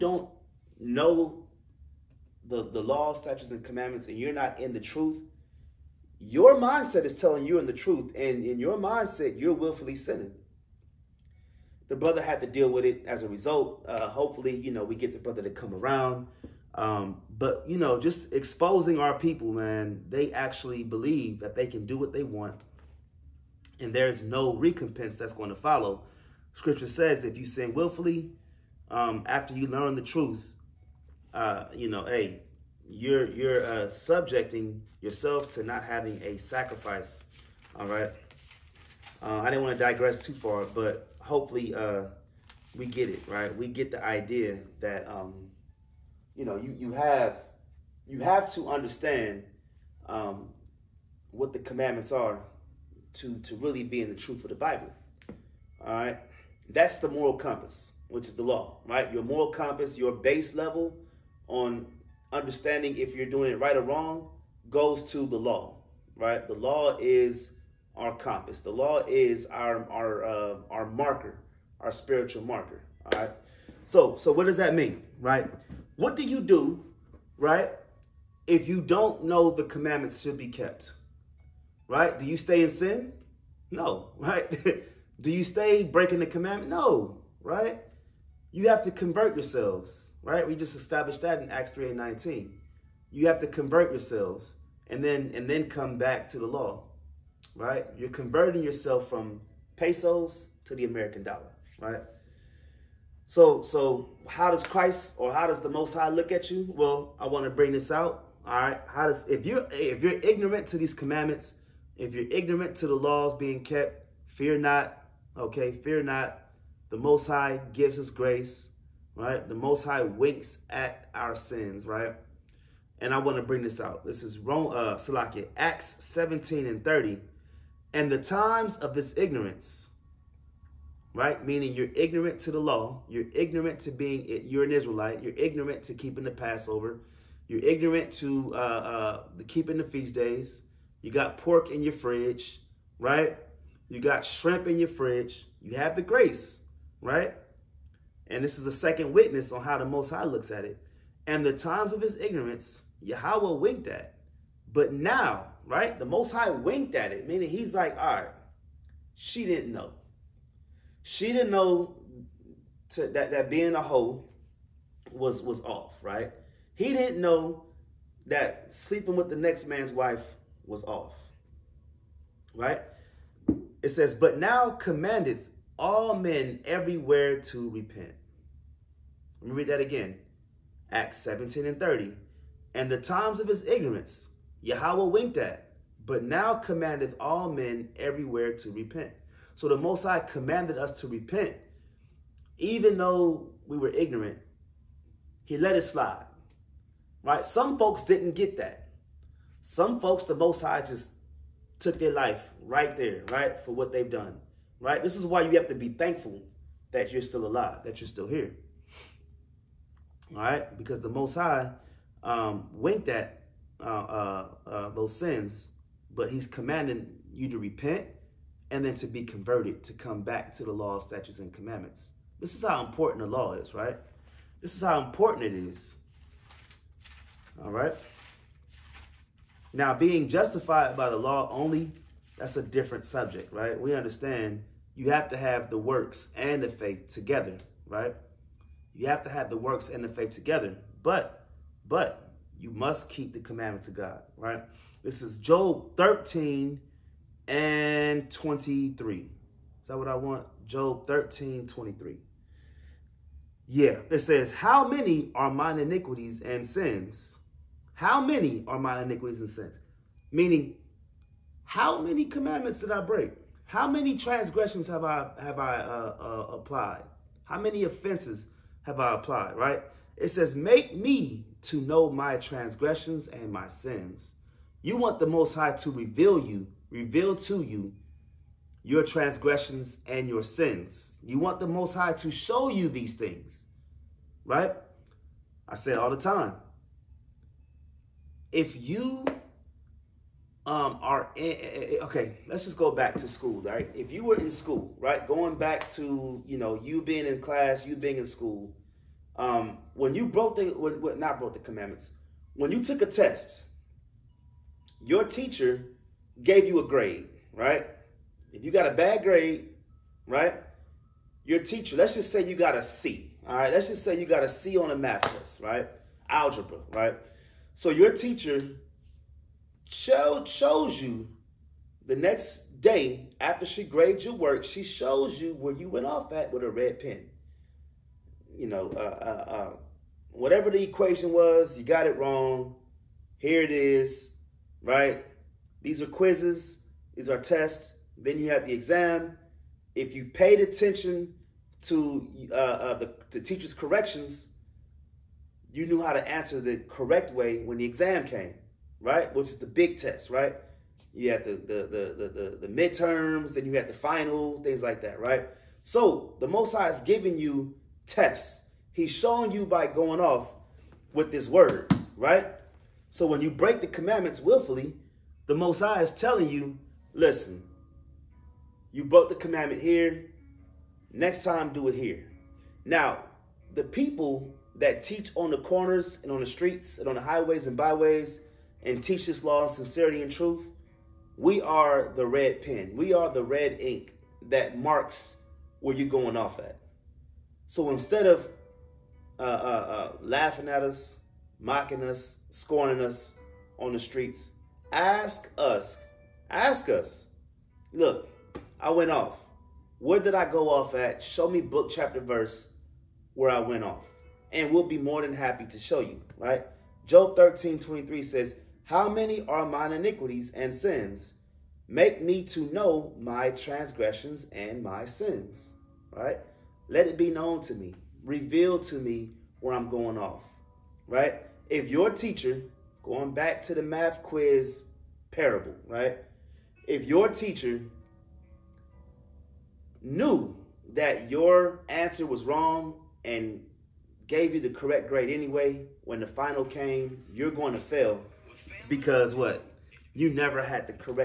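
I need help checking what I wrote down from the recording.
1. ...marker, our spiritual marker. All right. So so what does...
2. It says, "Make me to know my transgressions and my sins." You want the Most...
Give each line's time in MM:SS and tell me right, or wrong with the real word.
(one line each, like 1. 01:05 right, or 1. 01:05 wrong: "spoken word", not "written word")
1. 01:10 right
2. 04:30 right.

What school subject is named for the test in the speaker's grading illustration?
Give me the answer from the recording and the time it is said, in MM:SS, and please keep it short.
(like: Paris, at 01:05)
Algebra, at 05:16.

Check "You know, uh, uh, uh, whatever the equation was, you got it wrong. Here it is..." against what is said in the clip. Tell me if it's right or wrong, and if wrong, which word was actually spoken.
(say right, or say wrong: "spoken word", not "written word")
right.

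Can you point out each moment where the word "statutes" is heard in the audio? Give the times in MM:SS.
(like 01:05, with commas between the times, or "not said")
00:03, 03:40.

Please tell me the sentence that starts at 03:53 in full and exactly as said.
We understand you have to have the works and the faith together, right?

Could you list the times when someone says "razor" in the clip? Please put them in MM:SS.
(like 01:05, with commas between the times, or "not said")
not said.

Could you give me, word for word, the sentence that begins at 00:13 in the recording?
Uh, hopefully, you know, we get the brother to come around.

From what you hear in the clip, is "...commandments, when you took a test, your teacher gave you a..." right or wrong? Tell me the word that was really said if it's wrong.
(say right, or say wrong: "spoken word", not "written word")
right.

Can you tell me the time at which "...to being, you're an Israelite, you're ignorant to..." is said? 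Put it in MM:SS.
02:13.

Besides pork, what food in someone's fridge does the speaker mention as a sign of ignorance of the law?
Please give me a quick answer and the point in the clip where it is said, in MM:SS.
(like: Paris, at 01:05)
shrimp, at 02:24.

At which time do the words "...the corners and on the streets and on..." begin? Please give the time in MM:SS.
06:15.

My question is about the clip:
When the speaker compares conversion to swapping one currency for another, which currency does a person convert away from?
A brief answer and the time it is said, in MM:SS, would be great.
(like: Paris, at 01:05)
pesos, at 01:39.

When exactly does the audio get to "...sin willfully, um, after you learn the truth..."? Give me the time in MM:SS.
00:27.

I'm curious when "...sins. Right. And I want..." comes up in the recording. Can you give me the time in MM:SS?
02:01.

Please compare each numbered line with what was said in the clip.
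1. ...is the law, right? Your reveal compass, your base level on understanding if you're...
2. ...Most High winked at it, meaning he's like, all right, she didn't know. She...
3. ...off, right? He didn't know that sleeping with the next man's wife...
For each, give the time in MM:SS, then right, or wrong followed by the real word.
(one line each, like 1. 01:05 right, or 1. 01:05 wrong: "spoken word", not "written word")
1. 00:58 wrong: "moral", not "reveal"
2. 02:36 right
3. 02:45 right.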